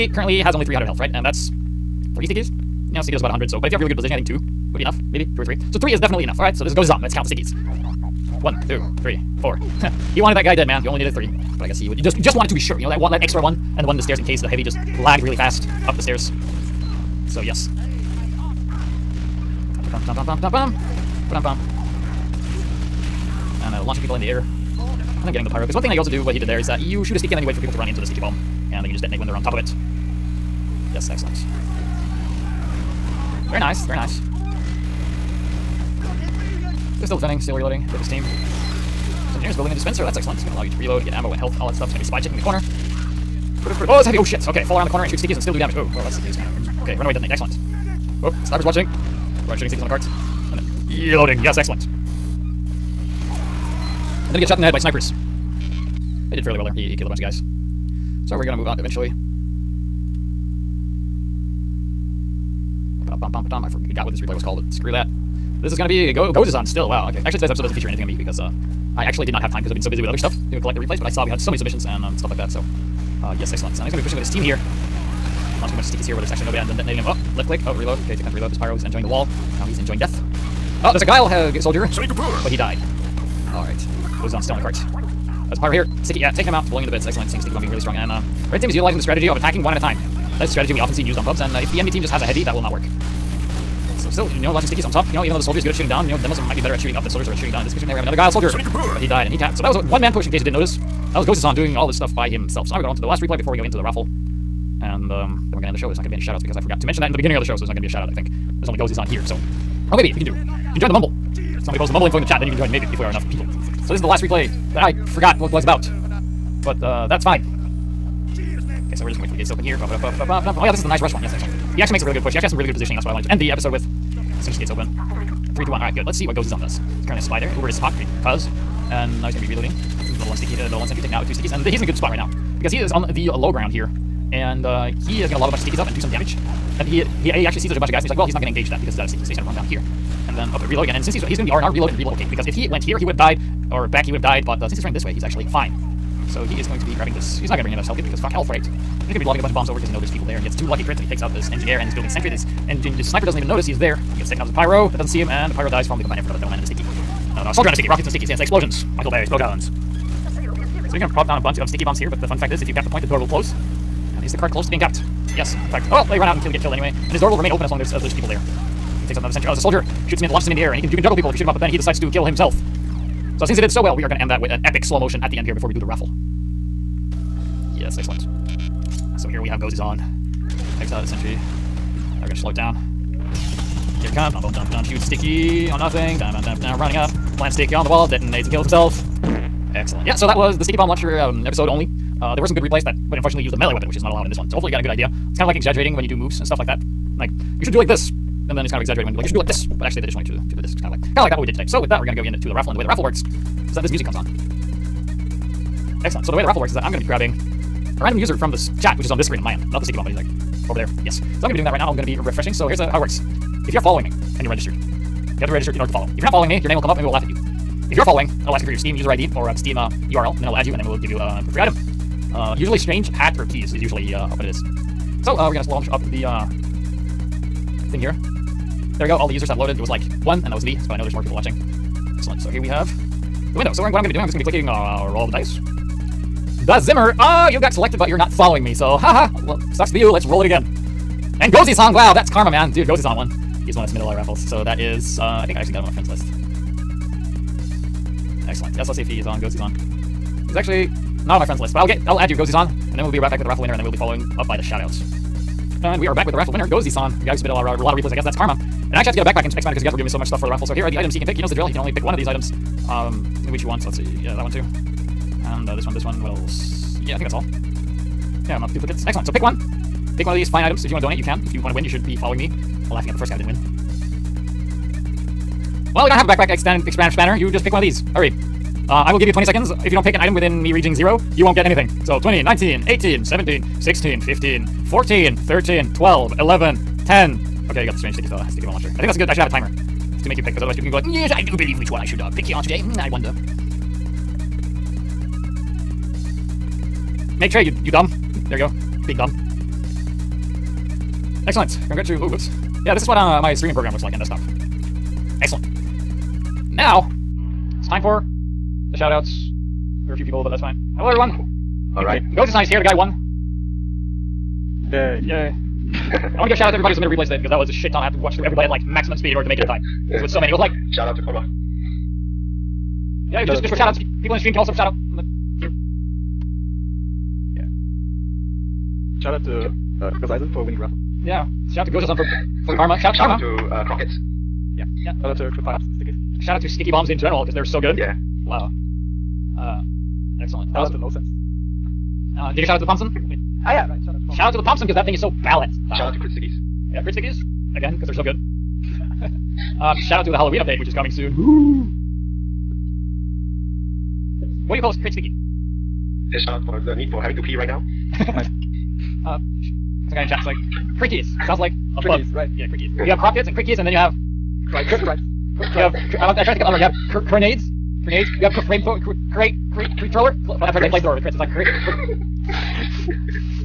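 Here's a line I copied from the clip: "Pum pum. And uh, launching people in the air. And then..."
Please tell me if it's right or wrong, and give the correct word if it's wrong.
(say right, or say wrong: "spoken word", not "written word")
right.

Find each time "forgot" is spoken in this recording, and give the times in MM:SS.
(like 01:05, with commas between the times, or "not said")
01:03, 01:46, 01:55.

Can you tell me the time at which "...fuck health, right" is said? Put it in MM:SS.
02:28.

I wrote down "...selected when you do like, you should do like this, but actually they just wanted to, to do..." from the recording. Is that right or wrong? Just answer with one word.
wrong.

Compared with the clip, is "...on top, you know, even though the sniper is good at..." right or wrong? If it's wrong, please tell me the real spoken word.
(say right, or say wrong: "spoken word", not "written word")
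wrong: "soldier", not "sniper".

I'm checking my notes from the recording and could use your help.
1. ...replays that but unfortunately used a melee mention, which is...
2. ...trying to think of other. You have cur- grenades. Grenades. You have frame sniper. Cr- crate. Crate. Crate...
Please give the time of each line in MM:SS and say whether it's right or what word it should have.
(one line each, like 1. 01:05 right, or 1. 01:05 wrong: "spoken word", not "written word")
1. 03:12 wrong: "weapon", not "mention"
2. 06:06 wrong: "thrower", not "sniper".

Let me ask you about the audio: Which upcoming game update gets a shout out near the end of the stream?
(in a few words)
Halloween update.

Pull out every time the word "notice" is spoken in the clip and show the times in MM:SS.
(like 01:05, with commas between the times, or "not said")
01:40, 02:33.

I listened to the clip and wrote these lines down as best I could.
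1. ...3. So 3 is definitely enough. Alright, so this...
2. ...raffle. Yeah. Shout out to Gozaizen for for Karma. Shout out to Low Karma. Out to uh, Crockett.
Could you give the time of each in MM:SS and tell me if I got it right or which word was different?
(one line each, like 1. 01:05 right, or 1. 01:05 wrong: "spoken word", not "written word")
1. 00:05 right
2. 05:30 wrong: "Shout", not "Low".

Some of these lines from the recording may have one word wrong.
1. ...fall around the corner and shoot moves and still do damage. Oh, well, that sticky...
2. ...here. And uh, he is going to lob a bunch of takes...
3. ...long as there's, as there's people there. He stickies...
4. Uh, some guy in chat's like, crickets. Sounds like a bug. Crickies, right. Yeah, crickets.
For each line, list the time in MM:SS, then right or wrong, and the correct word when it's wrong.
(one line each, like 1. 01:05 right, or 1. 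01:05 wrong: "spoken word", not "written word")
1. 00:44 wrong: "stickies", not "moves"
2. 02:13 wrong: "stickies", not "takes"
3. 02:47 wrong: "takes", not "stickies"
4. 05:59 right.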